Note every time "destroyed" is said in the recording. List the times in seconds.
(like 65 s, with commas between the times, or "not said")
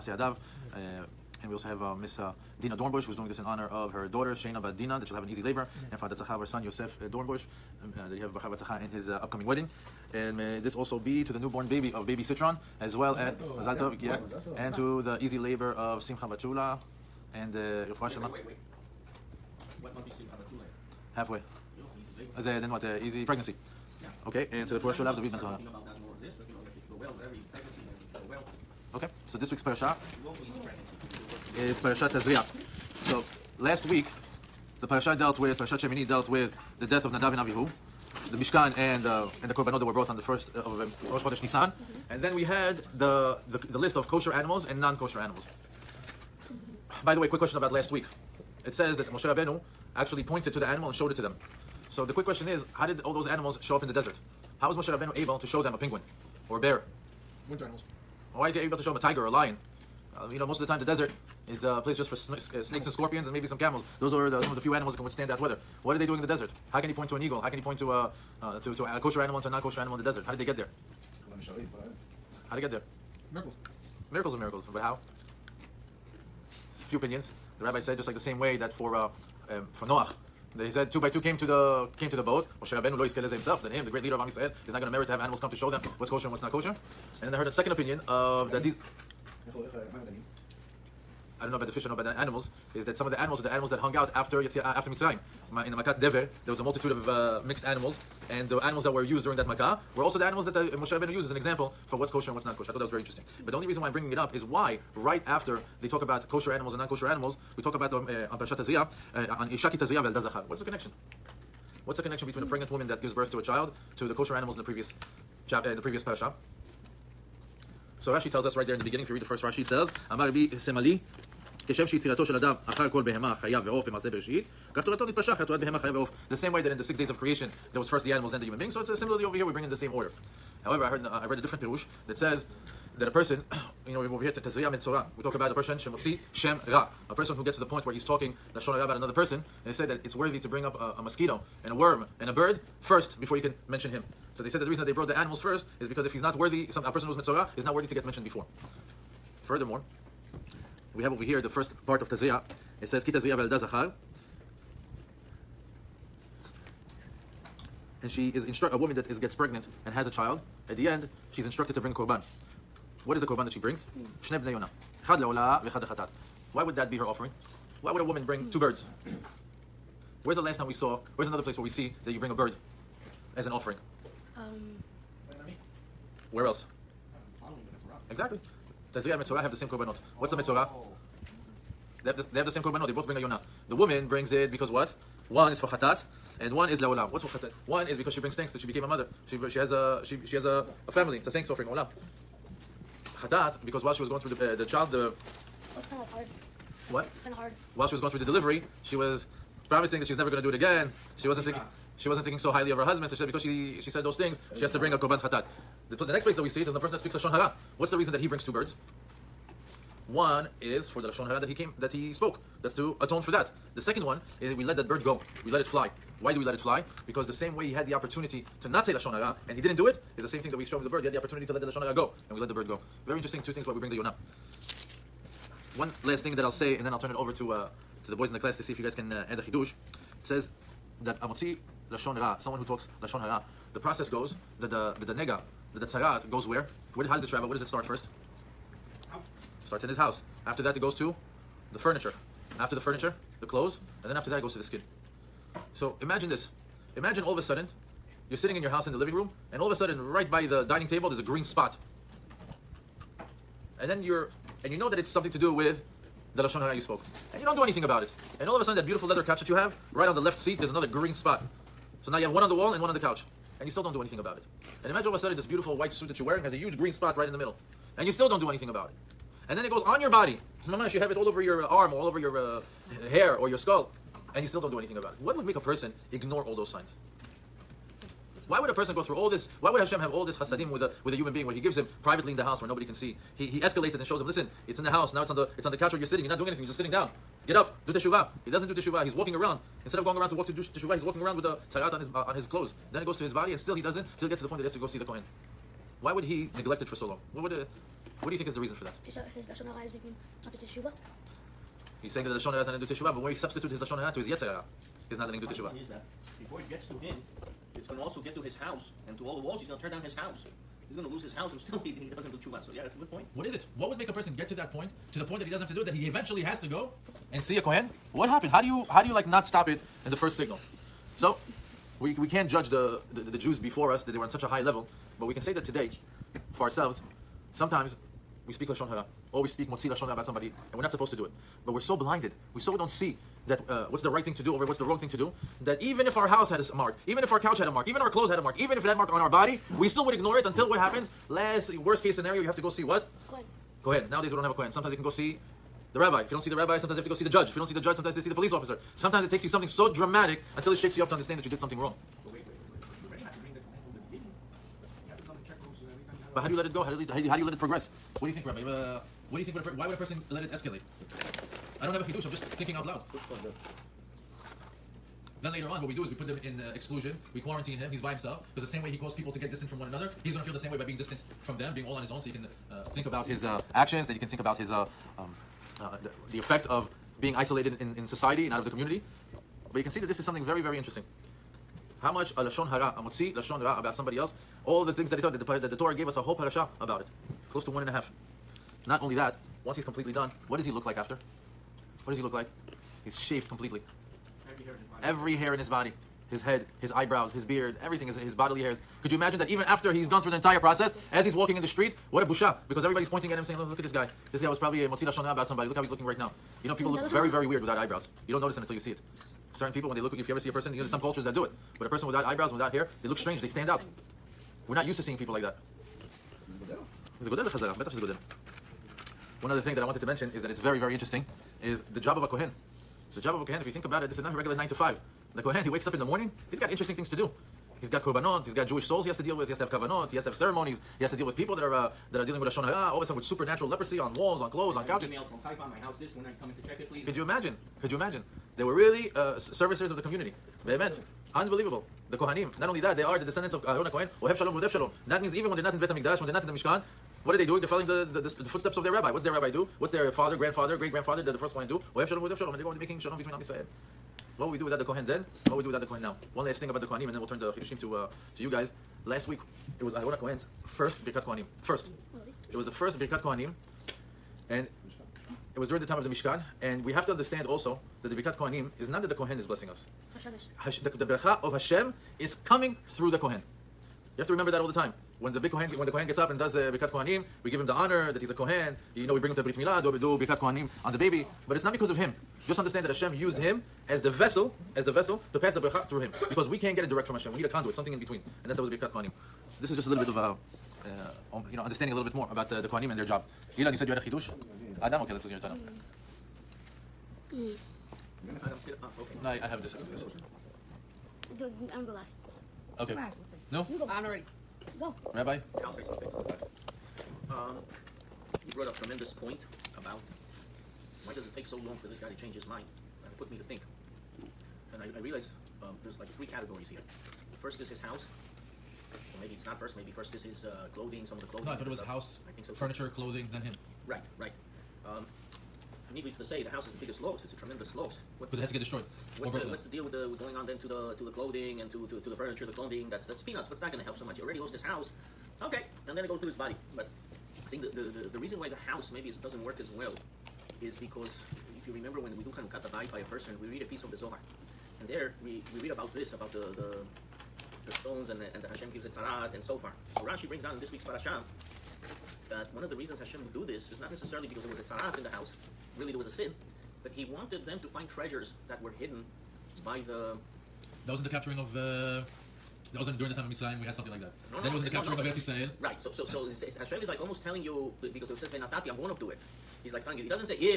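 528 s.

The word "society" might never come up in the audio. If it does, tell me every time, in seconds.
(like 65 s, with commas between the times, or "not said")
378 s.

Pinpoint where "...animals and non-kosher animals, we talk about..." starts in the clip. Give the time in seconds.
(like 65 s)
106 s.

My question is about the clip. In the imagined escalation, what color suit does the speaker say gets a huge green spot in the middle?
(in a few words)
white.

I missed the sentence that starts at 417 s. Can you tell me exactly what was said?
זה גודל בחזרה, בטח שזה גודל.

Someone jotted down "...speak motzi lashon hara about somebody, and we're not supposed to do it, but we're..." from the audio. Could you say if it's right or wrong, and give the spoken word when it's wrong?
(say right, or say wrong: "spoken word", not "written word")
right.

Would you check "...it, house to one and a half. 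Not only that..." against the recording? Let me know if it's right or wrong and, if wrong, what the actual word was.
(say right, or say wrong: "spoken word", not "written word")
wrong: "close", not "house".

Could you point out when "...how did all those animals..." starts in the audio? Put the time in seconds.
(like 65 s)
52 s.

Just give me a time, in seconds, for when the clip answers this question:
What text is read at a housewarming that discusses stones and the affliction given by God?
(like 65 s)
543 s.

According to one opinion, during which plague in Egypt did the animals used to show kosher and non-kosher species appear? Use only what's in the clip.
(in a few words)
Makat Dever.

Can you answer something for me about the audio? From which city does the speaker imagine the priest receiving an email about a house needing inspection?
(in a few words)
Haifa.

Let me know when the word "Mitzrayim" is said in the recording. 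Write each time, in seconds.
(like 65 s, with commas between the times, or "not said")
94 s, 563 s.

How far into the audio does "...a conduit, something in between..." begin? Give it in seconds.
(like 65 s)
487 s.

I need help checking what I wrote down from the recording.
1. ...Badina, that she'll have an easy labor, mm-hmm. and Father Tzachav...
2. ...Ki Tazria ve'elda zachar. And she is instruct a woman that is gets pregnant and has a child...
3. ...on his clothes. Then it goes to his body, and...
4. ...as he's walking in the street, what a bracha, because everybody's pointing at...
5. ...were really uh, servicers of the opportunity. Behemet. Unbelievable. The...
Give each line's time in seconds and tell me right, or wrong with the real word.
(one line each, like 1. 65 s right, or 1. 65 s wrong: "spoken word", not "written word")
1. 4 s right
2. 153 s right
3. 292 s right
4. 401 s wrong: "busha", not "bracha"
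5. 438 s wrong: "community", not "opportunity".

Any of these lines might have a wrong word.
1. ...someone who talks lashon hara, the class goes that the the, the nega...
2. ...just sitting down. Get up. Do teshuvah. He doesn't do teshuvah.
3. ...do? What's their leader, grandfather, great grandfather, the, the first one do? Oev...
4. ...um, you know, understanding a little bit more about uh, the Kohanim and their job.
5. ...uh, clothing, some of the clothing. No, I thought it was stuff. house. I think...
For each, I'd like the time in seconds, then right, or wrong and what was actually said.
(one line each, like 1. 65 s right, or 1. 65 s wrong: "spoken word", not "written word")
1. 232 s wrong: "process", not "class"
2. 286 s right
3. 449 s wrong: "father", not "leader"
4. 491 s right
5. 520 s right.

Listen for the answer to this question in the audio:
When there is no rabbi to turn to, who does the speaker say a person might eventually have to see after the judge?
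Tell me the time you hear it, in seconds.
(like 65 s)
348 s.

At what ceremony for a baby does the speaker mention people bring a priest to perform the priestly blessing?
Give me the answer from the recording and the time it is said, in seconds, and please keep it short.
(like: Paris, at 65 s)
Brit Milah, at 479 s.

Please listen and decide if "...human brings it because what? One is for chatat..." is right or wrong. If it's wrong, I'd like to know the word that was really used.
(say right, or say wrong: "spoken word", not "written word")
wrong: "woman", not "human".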